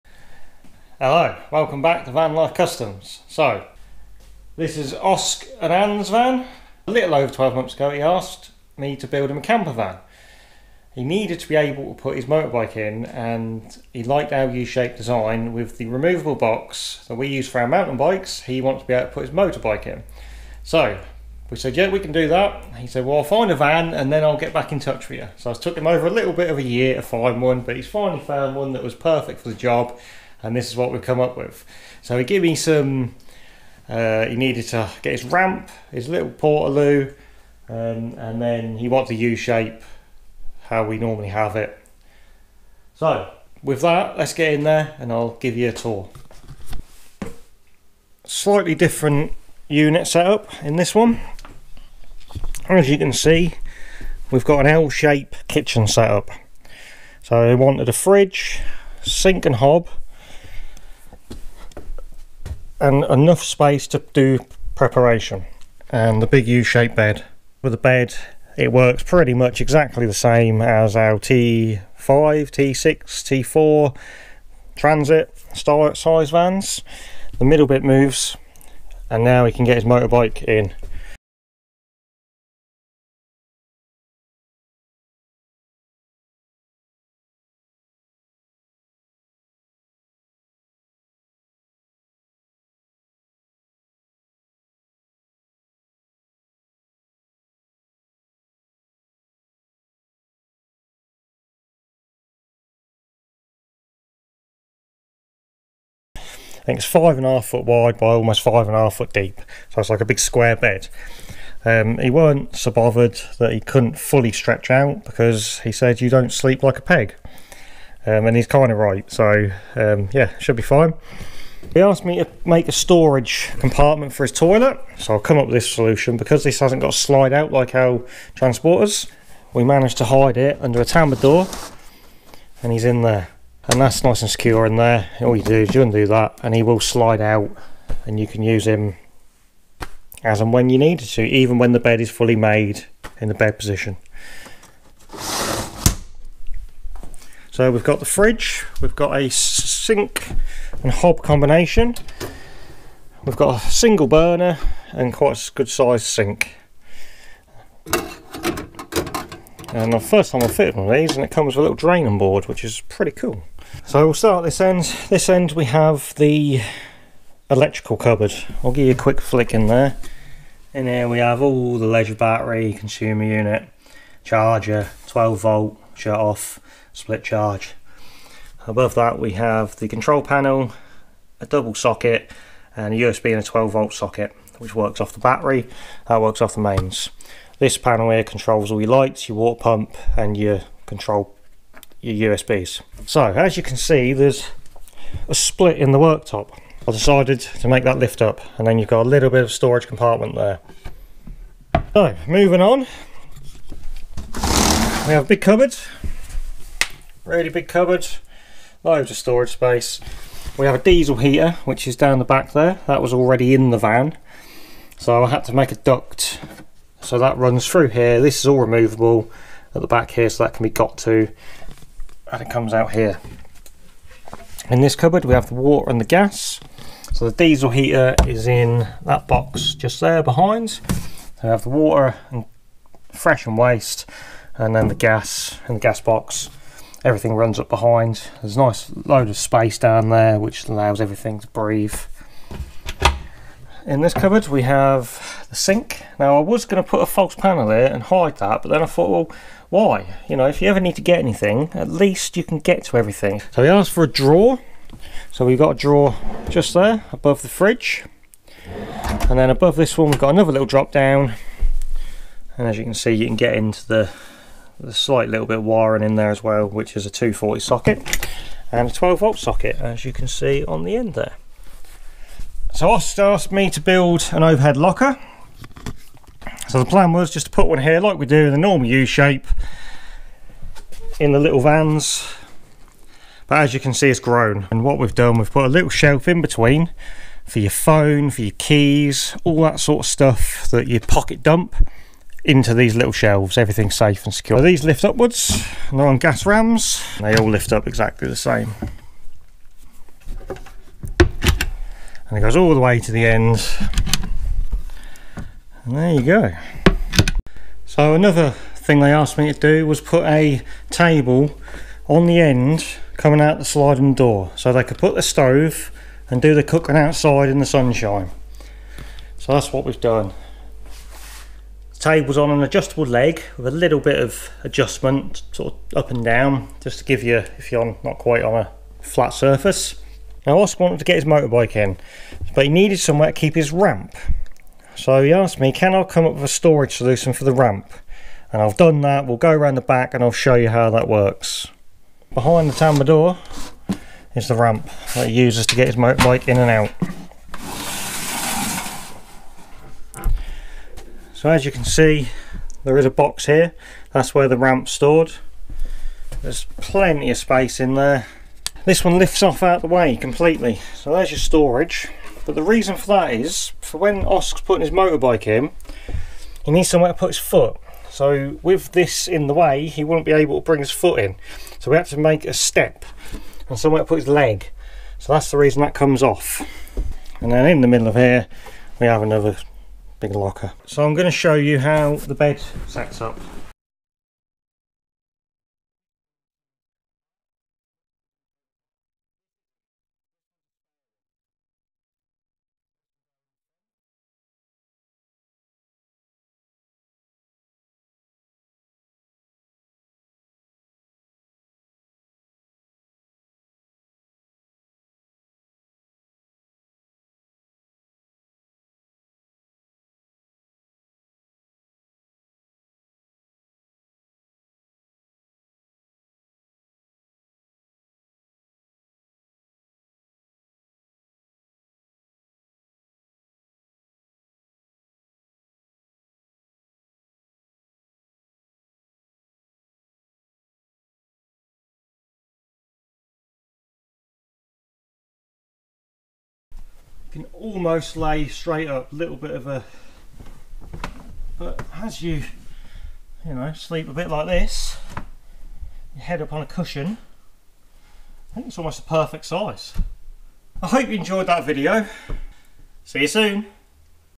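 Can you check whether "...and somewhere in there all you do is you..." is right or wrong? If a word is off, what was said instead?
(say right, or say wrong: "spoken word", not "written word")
wrong: "secure", not "somewhere".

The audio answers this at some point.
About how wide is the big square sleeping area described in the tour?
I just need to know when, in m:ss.
1:46.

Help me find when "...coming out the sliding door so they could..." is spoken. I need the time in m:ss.
5:13.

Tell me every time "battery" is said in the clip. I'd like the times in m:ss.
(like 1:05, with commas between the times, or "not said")
2:52, 3:05.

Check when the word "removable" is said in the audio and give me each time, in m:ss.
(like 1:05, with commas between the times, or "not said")
0:15, 3:38.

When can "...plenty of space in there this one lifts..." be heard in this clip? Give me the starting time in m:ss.
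5:56.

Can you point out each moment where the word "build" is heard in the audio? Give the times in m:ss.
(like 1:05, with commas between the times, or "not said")
0:09, 4:33.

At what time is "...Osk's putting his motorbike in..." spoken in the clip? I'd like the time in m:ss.
6:04.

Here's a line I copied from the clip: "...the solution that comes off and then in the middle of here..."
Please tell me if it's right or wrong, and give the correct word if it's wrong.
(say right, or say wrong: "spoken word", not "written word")
wrong: "reason", not "solution".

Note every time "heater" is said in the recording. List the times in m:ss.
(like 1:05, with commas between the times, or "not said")
3:31, 3:47.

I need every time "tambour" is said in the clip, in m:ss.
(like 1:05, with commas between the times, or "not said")
2:10, 5:42.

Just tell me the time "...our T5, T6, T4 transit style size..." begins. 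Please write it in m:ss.
1:10.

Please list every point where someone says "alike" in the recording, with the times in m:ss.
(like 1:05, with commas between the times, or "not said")
not said.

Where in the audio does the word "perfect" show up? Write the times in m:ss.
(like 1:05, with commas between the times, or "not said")
0:28, 7:29.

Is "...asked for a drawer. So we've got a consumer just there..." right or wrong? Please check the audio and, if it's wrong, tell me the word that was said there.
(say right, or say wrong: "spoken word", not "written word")
wrong: "drawer", not "consumer".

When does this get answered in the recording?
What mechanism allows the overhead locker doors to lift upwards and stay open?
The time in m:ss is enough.
4:56.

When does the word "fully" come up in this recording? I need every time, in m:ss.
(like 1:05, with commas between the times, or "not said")
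1:53, 2:22.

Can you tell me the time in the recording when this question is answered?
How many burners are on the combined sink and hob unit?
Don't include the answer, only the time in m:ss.
2:33.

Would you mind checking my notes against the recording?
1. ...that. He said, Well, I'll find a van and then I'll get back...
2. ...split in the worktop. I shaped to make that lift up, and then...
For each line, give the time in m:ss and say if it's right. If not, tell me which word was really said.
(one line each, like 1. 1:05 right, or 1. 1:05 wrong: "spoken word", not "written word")
1. 0:22 right
2. 3:15 wrong: "decided", not "shaped".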